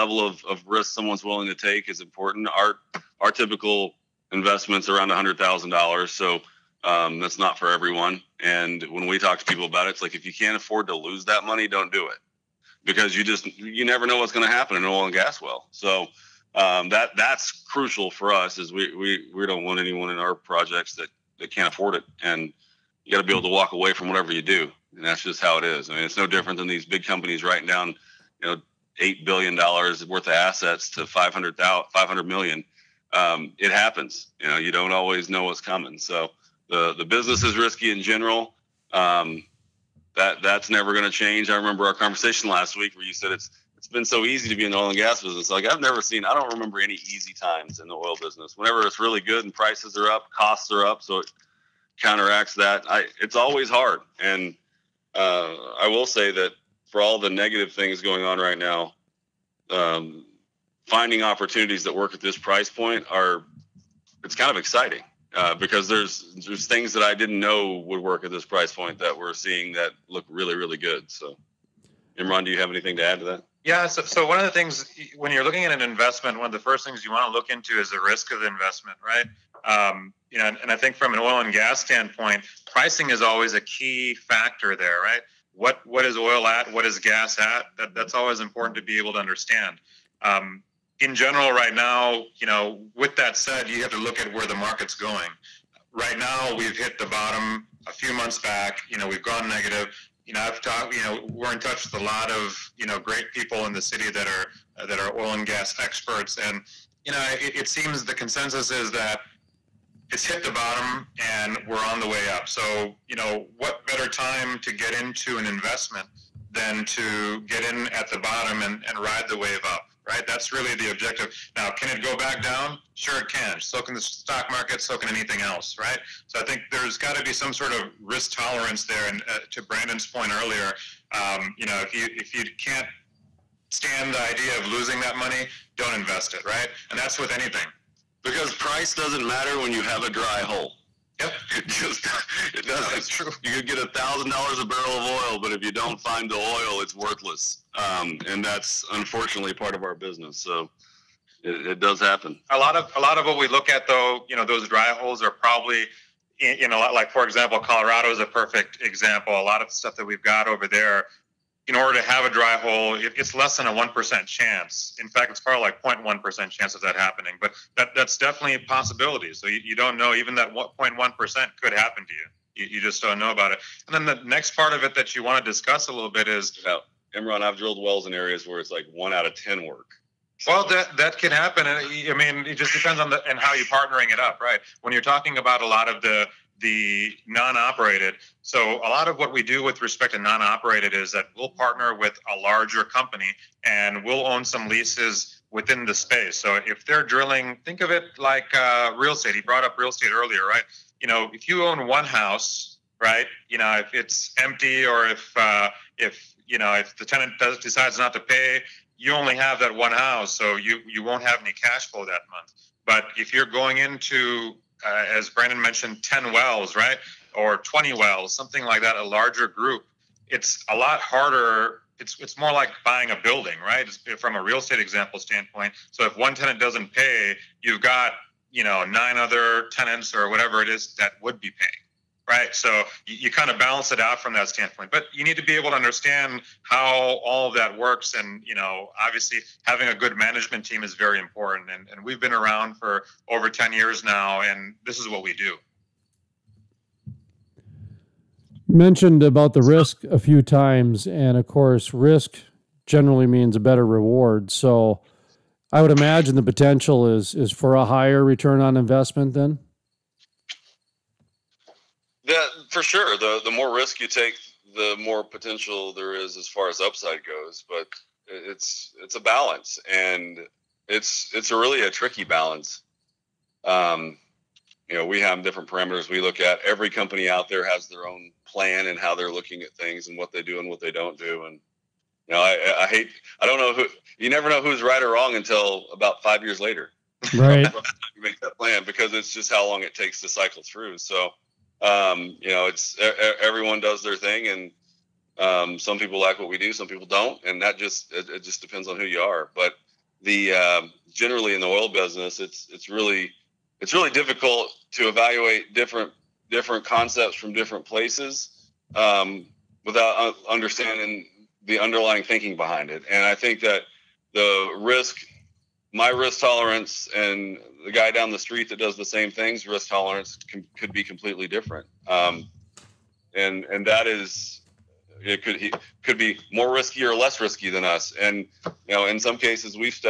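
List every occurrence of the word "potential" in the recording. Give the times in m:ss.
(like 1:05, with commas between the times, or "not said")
4:16, 4:25.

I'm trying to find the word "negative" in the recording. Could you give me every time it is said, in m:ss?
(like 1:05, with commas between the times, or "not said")
0:57, 1:39.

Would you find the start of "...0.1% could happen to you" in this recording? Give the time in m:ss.
2:50.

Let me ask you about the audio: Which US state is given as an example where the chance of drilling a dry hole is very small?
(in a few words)
Colorado.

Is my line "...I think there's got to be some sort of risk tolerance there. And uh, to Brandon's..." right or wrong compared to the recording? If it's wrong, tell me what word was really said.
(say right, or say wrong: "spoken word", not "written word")
right.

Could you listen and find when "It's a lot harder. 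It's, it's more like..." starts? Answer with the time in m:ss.
3:40.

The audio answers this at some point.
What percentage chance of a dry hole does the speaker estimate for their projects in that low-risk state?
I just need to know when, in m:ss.
2:45.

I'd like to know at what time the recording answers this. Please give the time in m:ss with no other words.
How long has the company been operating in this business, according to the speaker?
4:03.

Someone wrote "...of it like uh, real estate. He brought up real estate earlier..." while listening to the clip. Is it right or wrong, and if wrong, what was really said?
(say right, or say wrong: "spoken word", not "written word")
right.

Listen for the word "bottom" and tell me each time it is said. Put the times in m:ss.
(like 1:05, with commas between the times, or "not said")
1:37, 1:50, 1:58.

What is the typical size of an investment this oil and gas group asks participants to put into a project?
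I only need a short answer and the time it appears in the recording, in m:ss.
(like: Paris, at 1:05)
$100,000, at 0:05.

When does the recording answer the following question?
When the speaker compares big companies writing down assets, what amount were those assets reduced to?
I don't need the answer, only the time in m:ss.
0:31.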